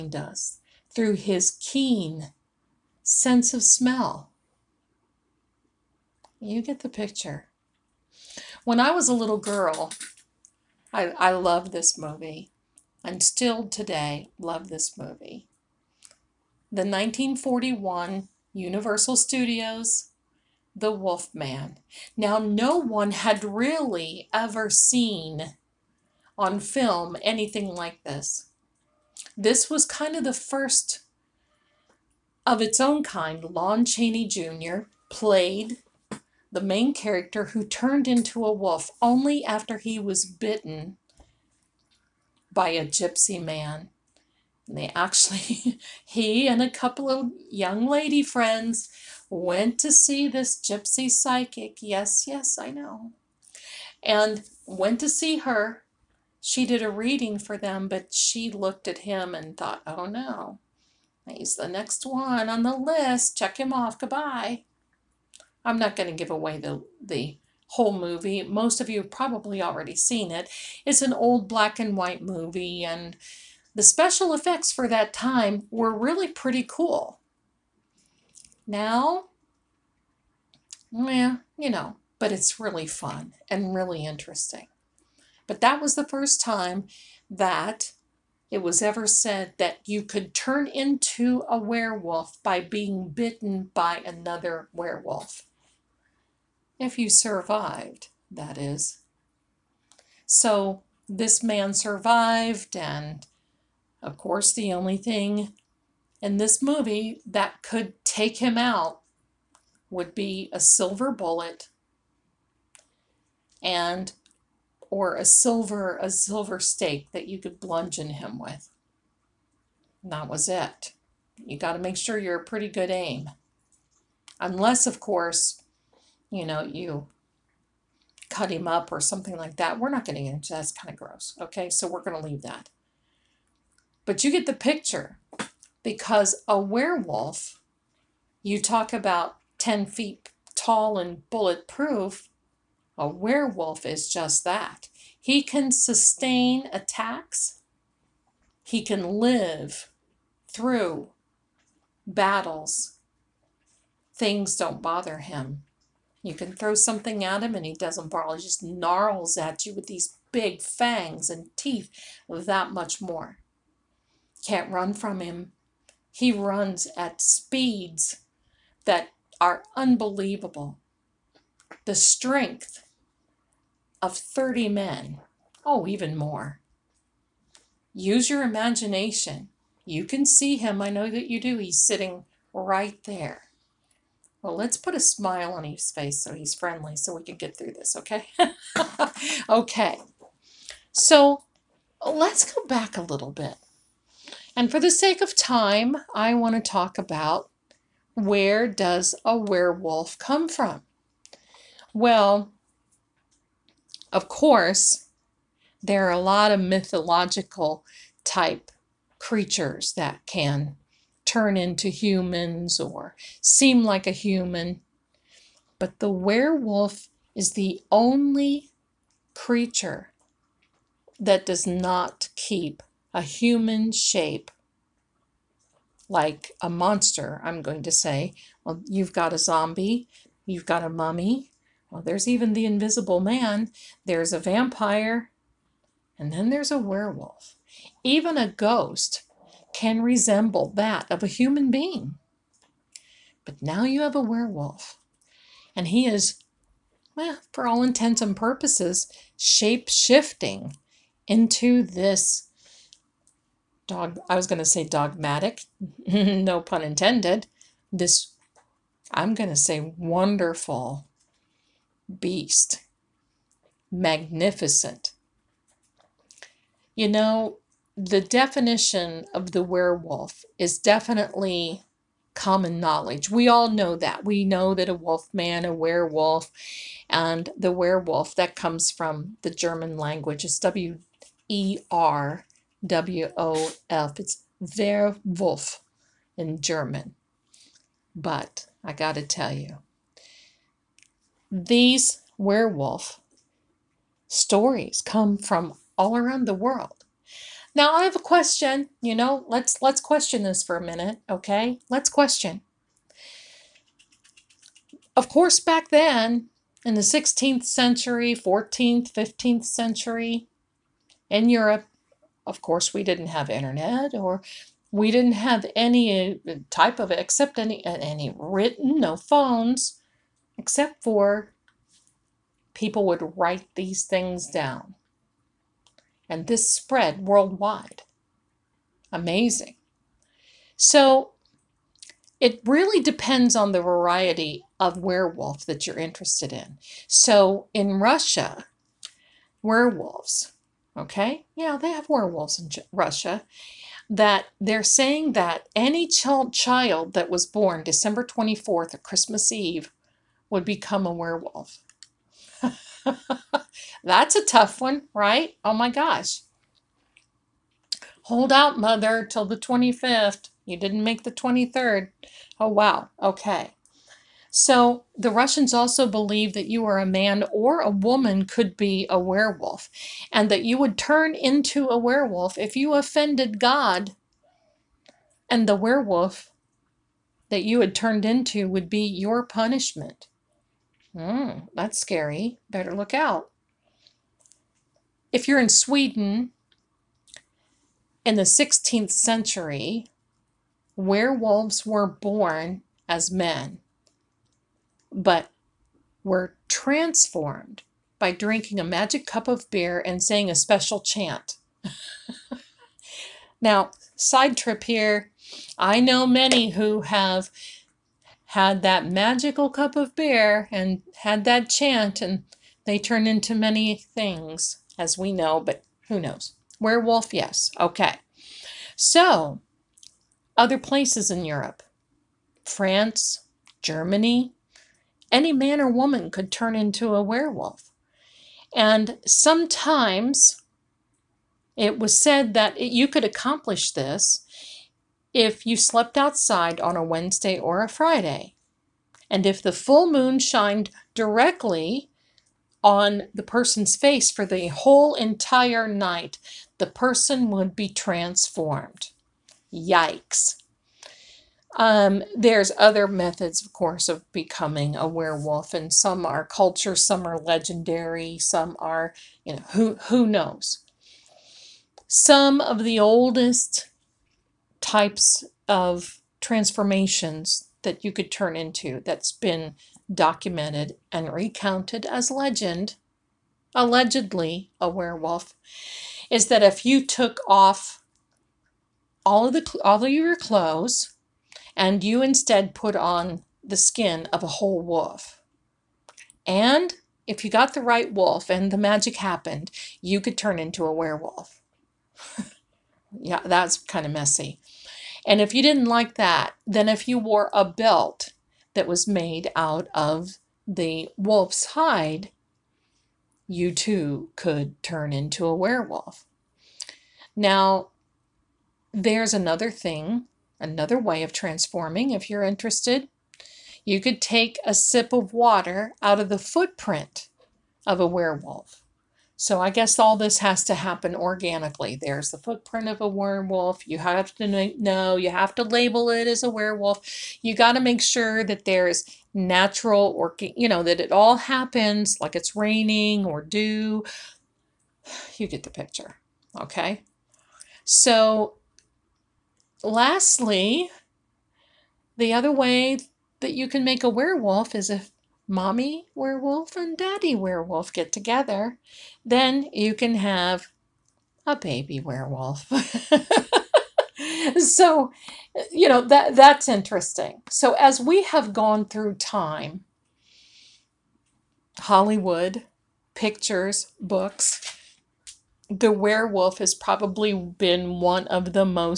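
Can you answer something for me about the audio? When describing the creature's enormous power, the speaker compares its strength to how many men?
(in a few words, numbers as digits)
30.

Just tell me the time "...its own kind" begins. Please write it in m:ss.
0:32.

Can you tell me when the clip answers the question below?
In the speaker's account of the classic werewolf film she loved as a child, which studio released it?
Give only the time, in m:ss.
0:18.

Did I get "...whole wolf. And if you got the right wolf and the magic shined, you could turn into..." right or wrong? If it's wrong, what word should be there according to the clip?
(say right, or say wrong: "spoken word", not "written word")
wrong: "happened", not "shined".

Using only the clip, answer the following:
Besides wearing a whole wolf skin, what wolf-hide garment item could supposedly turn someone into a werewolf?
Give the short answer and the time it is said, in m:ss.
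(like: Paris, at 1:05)
a belt, at 8:17.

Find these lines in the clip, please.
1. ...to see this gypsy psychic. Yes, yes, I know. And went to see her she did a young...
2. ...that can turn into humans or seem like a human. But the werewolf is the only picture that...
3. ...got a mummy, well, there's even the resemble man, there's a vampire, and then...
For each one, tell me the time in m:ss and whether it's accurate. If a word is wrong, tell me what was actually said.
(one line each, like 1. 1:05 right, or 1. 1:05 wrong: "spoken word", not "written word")
1. 0:49 wrong: "reading", not "young"
2. 3:29 wrong: "creature", not "picture"
3. 3:50 wrong: "invisible", not "resemble".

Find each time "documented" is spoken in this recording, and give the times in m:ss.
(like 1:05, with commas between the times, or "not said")
7:50.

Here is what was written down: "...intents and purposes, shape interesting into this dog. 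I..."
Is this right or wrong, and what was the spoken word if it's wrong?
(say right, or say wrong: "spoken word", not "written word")
wrong: "shifting", not "interesting".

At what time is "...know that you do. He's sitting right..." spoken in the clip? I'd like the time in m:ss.
3:00.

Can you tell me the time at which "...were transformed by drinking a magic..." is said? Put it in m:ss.
6:36.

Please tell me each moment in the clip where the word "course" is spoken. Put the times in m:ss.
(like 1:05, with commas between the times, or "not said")
1:44, 2:04, 3:24, 5:05, 5:12, 7:33.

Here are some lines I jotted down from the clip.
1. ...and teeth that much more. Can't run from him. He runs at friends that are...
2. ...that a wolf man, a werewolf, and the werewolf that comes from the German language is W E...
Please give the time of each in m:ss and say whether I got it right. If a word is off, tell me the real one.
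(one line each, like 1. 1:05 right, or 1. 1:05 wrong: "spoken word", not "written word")
1. 2:41 wrong: "speeds", not "friends"
2. 4:34 right.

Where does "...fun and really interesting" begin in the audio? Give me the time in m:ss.
1:22.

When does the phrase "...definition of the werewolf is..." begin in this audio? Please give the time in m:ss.
4:28.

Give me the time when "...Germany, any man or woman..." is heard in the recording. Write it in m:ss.
7:03.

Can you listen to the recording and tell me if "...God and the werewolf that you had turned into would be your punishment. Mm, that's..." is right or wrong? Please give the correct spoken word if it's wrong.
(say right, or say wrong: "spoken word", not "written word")
right.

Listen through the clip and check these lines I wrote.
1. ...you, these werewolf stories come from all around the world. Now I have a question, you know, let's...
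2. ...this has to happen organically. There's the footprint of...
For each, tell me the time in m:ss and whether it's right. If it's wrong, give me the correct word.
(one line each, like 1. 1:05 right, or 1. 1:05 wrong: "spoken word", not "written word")
1. 4:49 right
2. 8:40 right.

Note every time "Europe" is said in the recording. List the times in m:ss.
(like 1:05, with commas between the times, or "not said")
5:11, 7:01.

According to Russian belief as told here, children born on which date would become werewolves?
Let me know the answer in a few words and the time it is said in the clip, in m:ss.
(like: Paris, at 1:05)
December 24th, at 5:47.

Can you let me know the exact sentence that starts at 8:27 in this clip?
Now, there's another thing, another way of transforming if you're interested.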